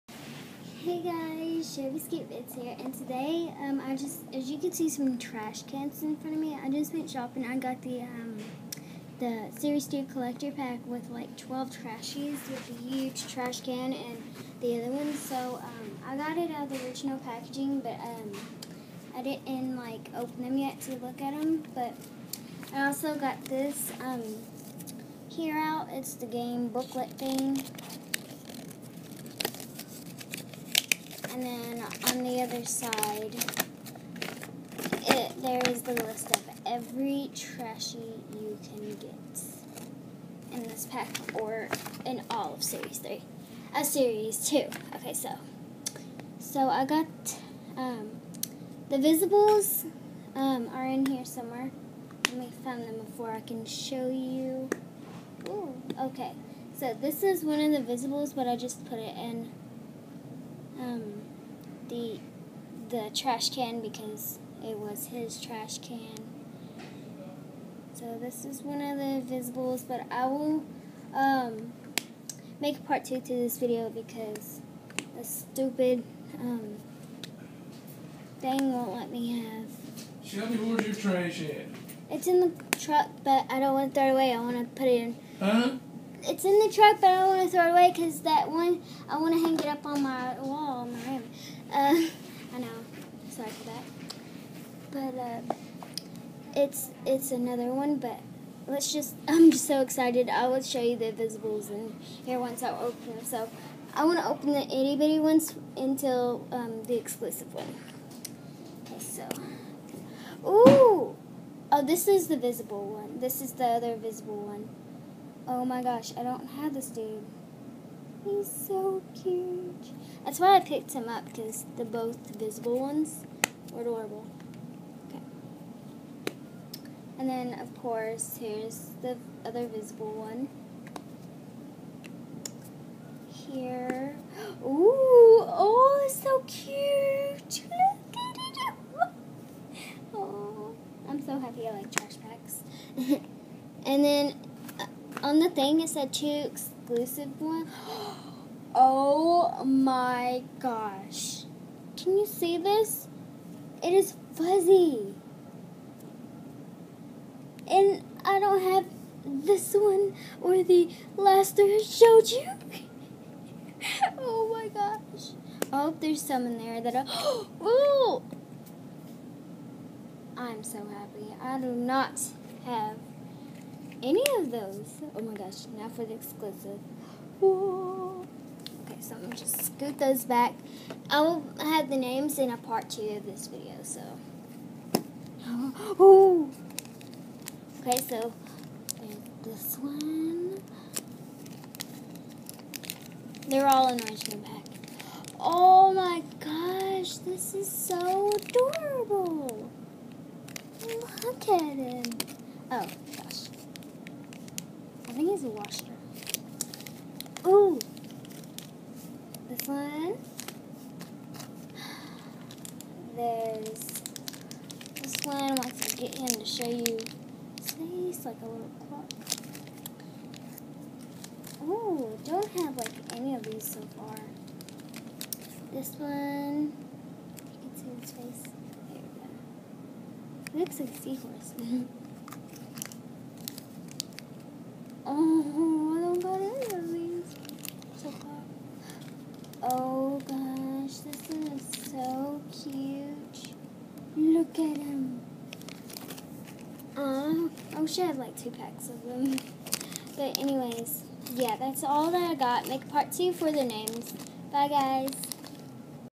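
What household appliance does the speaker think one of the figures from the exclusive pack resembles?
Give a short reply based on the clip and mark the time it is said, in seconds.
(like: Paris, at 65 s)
a washer, at 205 s.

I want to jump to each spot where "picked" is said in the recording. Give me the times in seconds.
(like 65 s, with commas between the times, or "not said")
120 s.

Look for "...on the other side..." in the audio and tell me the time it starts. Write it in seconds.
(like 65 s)
32 s.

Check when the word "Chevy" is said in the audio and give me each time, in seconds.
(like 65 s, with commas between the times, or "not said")
1 s.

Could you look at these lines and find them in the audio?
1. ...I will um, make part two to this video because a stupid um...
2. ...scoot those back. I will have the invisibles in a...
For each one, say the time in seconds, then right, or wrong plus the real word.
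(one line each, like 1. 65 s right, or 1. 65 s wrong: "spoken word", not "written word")
1. 70 s right
2. 179 s wrong: "names", not "invisibles".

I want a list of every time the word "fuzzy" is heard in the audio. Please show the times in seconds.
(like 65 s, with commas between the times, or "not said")
154 s.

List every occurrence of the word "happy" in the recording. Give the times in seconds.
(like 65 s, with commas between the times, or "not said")
141 s, 170 s.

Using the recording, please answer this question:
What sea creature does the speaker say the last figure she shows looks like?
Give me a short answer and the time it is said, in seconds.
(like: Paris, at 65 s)
a seahorse, at 230 s.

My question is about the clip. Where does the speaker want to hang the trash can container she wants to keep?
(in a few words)
on my wall.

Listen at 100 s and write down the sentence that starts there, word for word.
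I will show you the invisibles in here once I open them.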